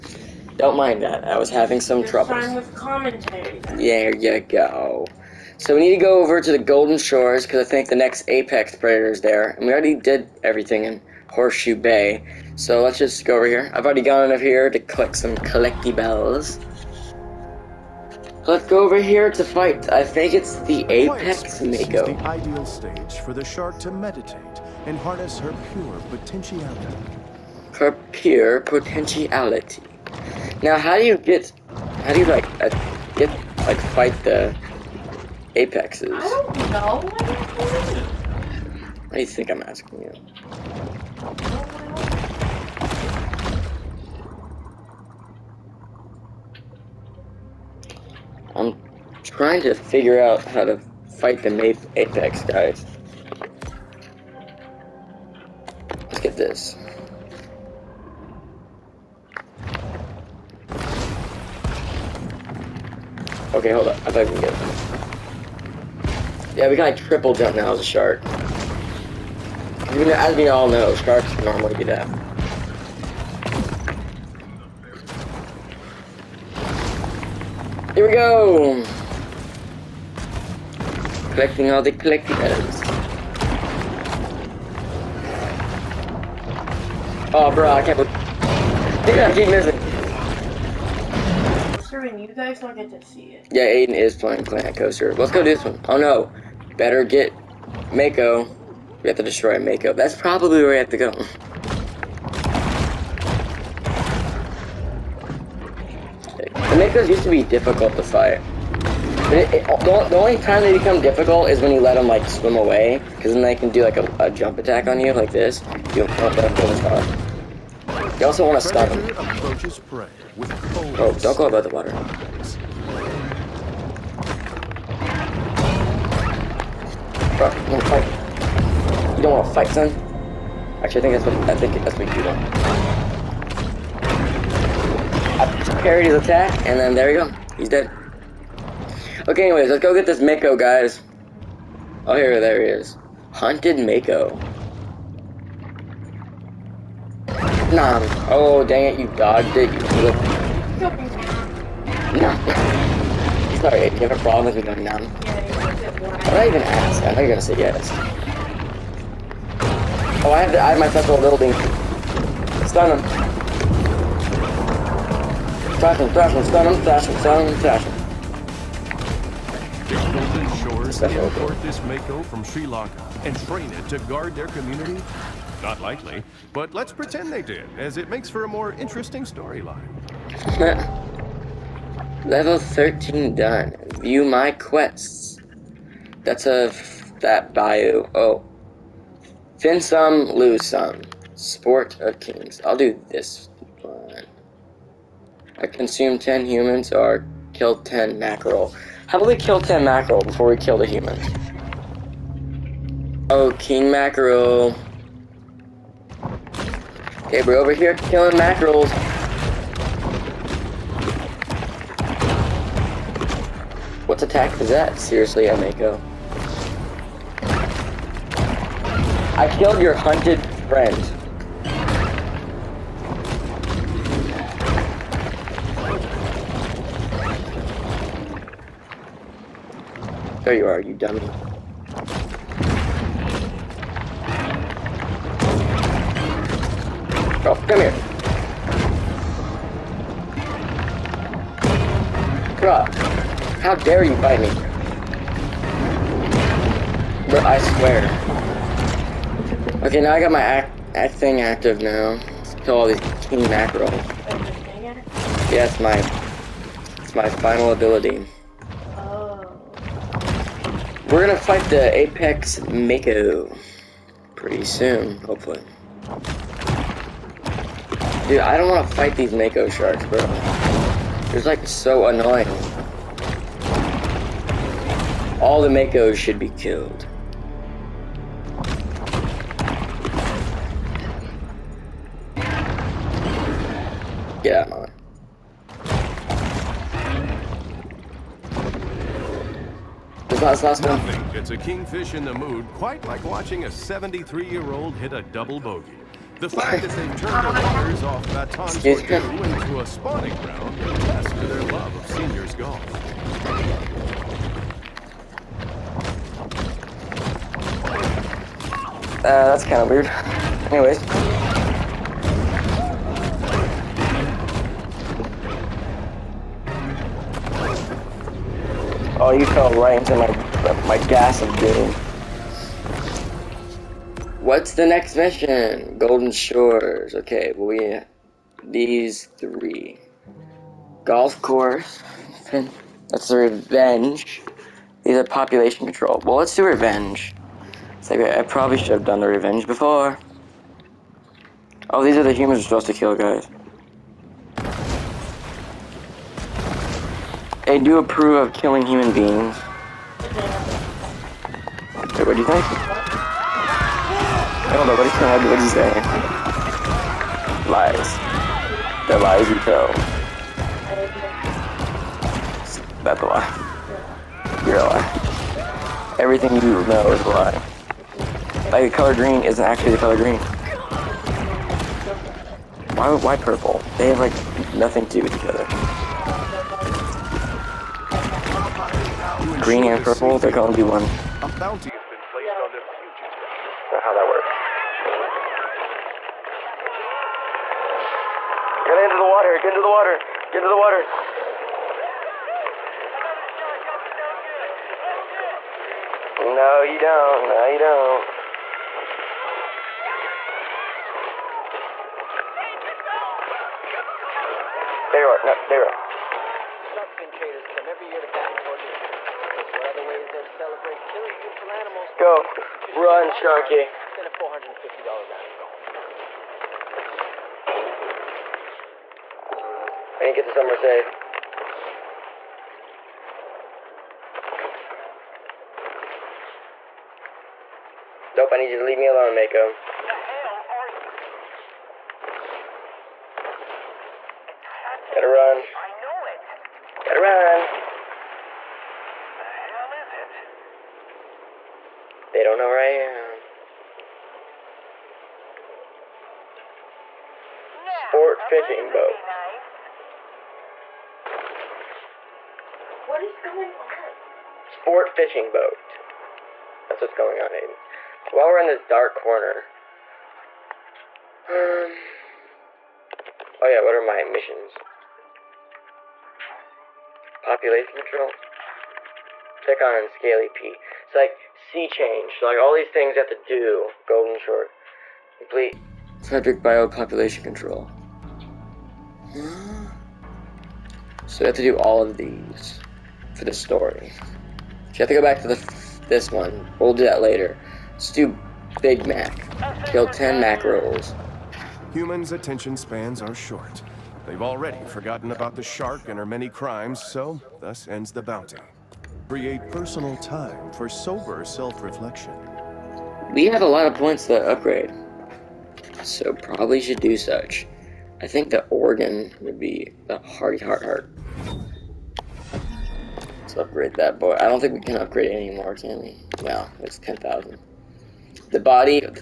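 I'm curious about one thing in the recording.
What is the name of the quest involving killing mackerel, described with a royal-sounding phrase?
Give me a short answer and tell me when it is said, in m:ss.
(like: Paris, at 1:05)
Sport of Kings, at 3:11.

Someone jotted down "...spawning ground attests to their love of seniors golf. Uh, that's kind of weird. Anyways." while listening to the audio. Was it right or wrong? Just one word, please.
right.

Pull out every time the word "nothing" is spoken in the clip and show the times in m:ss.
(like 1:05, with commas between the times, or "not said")
4:50, 6:14.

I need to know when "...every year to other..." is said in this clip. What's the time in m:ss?
6:47.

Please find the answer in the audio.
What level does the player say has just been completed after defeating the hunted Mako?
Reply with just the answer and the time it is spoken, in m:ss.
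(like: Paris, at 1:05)
13, at 3:02.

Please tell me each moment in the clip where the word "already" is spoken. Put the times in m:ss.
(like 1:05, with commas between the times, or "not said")
0:09, 0:13, 8:14.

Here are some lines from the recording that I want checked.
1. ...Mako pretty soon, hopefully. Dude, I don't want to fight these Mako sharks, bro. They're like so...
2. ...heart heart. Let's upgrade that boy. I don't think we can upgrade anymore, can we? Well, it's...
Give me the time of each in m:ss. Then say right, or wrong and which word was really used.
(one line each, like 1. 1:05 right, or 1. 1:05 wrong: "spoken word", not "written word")
1. 4:22 right
2. 8:30 right.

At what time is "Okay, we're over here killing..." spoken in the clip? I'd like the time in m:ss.
3:27.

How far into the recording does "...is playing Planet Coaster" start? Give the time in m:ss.
1:33.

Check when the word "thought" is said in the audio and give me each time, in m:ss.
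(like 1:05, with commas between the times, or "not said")
1:04, 2:37.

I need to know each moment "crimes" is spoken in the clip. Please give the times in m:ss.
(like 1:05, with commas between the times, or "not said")
8:16.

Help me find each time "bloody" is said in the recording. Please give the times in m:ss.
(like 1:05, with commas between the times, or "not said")
not said.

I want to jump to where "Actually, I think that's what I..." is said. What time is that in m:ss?
2:10.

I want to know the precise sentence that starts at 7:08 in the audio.
Nope, I need you to leave me alone, Mako.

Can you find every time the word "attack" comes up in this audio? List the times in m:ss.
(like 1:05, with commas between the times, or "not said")
1:54, 2:16, 3:34.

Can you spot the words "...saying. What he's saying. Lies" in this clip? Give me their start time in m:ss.
5:55.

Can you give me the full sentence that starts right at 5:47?
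They do approve of killing human beings.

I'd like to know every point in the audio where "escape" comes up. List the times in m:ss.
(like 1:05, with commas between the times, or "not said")
not said.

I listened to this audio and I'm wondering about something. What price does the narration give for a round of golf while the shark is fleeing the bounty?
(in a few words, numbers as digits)
$450.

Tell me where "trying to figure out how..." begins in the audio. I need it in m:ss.
0:49.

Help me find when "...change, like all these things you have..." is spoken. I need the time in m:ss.
7:51.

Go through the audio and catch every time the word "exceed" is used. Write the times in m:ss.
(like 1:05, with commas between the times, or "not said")
not said.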